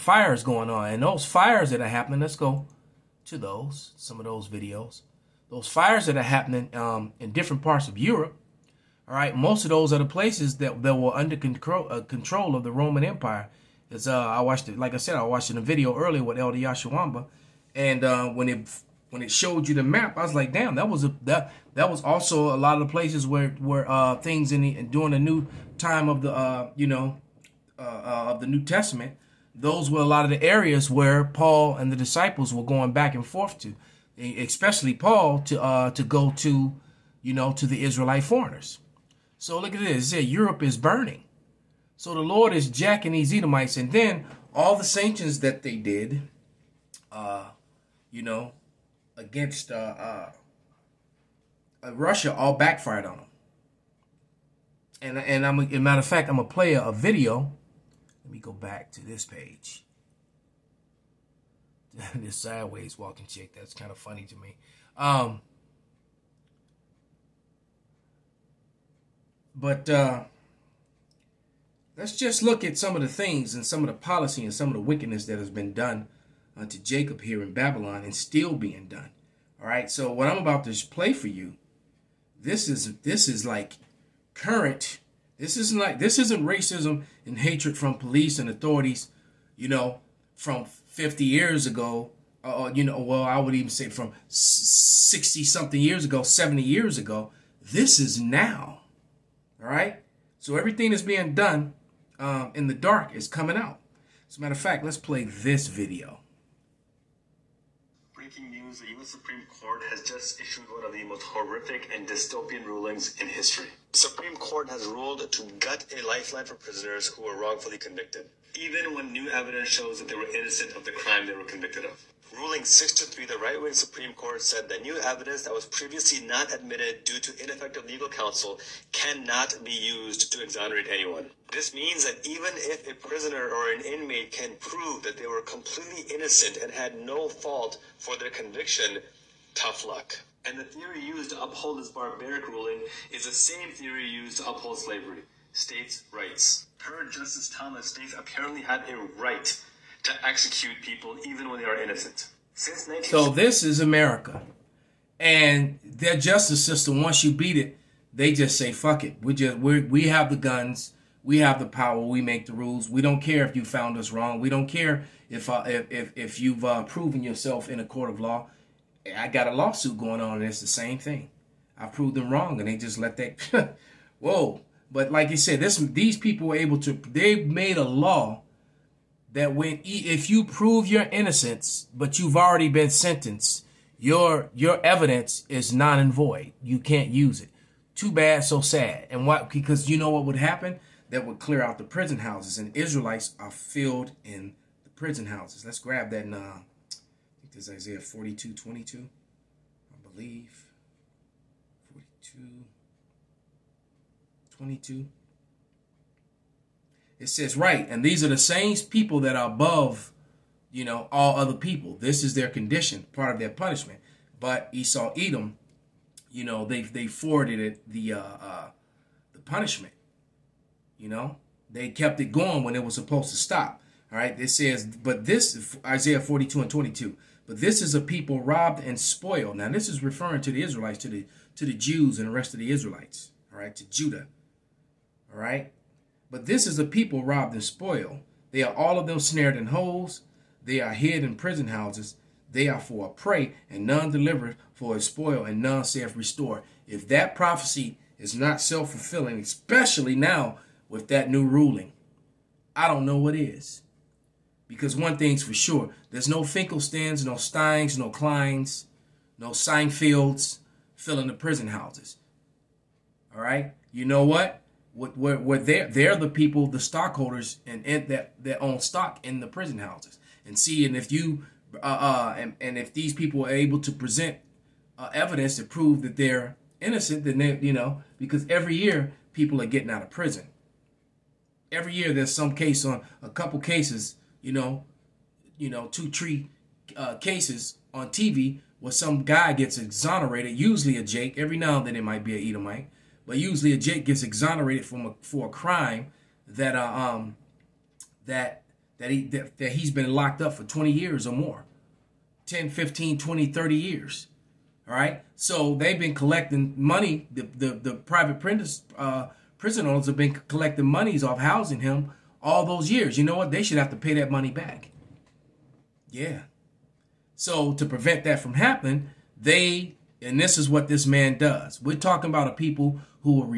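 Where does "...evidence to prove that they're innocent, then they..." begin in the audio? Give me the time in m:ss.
4:35.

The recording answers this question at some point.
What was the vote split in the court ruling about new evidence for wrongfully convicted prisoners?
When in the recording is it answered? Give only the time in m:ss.
2:02.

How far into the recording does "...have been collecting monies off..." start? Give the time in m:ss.
5:10.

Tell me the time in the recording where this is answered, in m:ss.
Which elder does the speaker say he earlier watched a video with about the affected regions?
0:16.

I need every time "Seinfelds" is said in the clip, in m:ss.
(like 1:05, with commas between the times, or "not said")
4:19.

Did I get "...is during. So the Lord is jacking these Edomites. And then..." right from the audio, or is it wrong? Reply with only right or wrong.
wrong.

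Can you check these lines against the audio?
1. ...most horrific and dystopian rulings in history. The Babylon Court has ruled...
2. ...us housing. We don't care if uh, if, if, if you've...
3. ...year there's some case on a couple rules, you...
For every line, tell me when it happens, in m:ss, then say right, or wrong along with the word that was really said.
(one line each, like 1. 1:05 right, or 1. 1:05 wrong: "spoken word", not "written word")
1. 1:51 wrong: "Supreme", not "Babylon"
2. 2:43 wrong: "wrong", not "housing"
3. 4:41 wrong: "cases", not "rules".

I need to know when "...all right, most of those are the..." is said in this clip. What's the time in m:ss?
0:09.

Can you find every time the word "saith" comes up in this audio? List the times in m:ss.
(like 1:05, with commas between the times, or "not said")
4:05.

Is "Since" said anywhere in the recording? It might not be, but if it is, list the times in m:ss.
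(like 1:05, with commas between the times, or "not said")
2:32.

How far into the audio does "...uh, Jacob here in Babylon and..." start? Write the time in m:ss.
1:16.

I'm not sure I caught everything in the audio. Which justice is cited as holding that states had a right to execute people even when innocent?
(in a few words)
Justice Thomas.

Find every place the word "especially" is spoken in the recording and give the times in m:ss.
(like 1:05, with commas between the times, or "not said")
0:34, 4:09.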